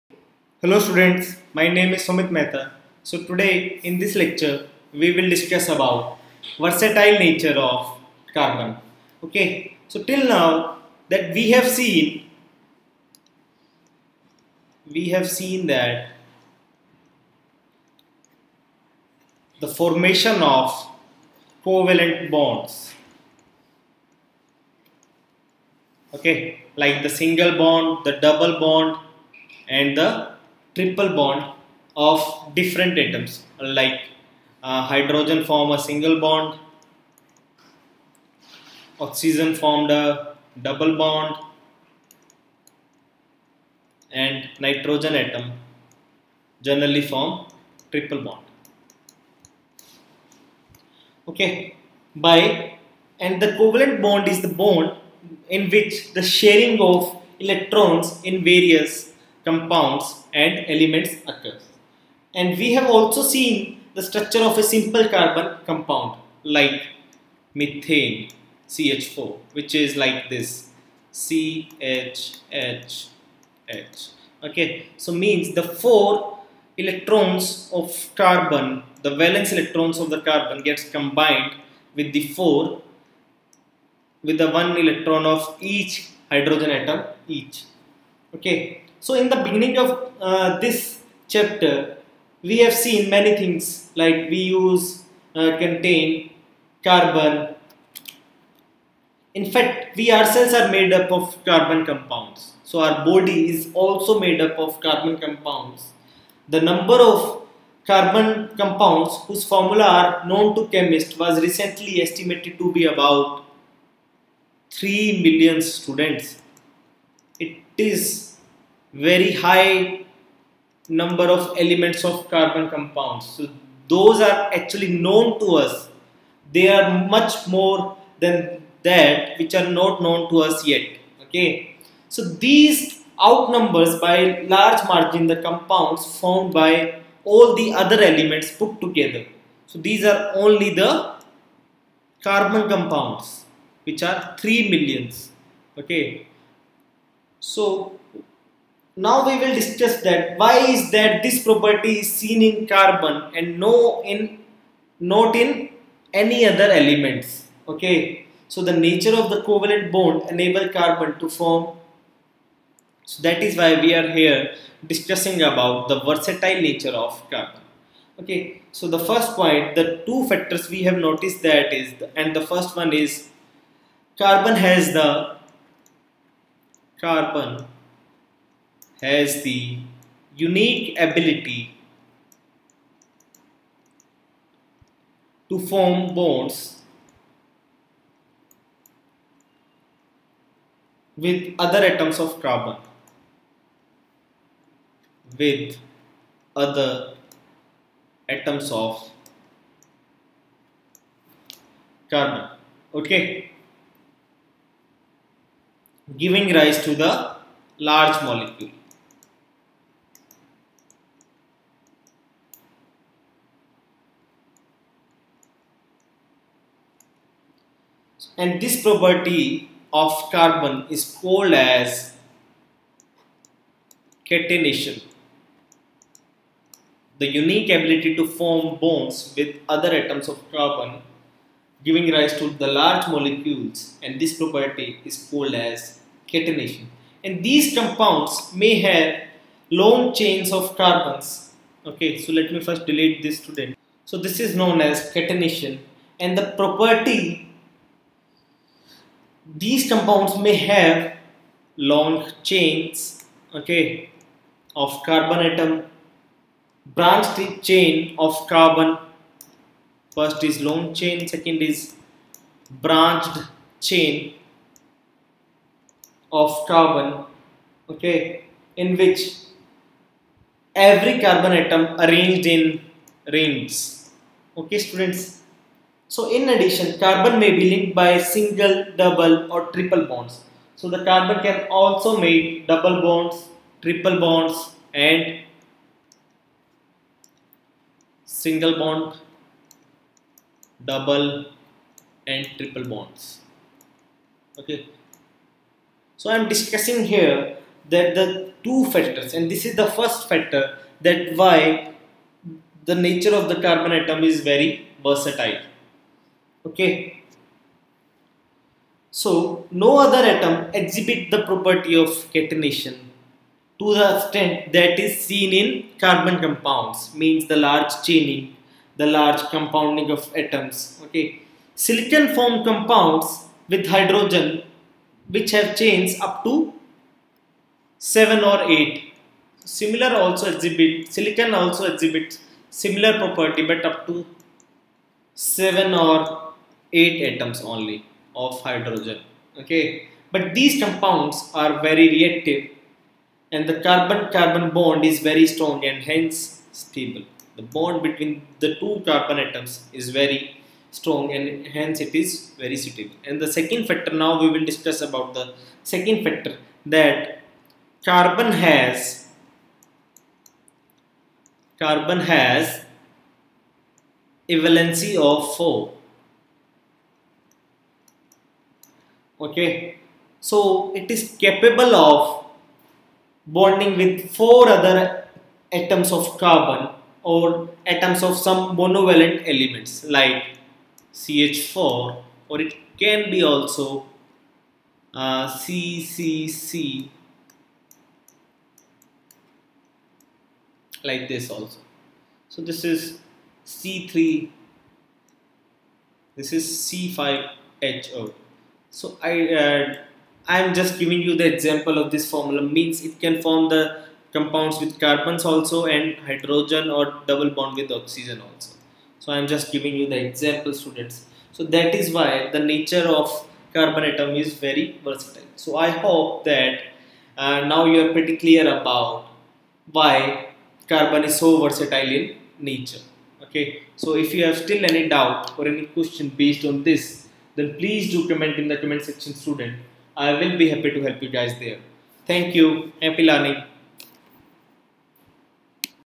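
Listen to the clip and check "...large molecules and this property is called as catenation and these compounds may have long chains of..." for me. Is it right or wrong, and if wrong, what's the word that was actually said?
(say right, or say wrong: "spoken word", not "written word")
right.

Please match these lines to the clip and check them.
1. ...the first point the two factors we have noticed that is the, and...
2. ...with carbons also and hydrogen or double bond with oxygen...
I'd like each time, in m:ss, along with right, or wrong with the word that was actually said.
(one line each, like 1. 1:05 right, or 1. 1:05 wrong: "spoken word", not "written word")
1. 2:48 right
2. 6:44 right.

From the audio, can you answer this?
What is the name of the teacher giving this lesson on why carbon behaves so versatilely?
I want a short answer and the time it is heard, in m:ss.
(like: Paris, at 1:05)
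Sumit Mehta, at 0:02.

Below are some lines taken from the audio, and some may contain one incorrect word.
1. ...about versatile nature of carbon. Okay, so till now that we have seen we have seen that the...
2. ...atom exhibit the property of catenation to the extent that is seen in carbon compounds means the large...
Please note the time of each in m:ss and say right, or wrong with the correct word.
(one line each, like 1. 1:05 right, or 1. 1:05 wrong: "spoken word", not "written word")
1. 0:05 right
2. 5:10 right.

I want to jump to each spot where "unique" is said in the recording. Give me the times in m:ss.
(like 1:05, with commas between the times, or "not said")
3:00, 3:47.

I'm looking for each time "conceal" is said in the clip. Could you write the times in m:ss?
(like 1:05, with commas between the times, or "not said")
not said.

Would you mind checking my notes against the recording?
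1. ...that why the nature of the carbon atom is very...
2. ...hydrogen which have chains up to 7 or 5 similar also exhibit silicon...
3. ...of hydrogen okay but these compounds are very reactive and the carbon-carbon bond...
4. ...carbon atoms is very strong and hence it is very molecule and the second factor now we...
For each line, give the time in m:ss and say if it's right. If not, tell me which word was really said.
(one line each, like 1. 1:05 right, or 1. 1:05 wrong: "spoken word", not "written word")
1. 5:00 right
2. 5:23 wrong: "8", not "5"
3. 5:38 right
4. 5:49 wrong: "suitable", not "molecule".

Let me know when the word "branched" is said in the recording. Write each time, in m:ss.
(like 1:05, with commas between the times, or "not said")
4:16, 4:22.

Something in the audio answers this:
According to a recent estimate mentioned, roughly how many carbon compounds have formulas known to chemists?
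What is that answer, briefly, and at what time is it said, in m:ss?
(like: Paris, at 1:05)
3 million, at 1:54.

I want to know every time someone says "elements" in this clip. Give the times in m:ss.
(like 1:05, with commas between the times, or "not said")
1:00, 2:01, 2:18, 2:36, 6:19.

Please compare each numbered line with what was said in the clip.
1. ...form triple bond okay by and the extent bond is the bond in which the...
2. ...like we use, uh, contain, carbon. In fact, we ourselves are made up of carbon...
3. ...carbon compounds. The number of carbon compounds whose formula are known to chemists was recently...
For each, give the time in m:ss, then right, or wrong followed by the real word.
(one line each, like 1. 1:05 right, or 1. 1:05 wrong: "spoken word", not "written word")
1. 0:47 wrong: "covalent", not "extent"
2. 1:33 right
3. 1:44 right.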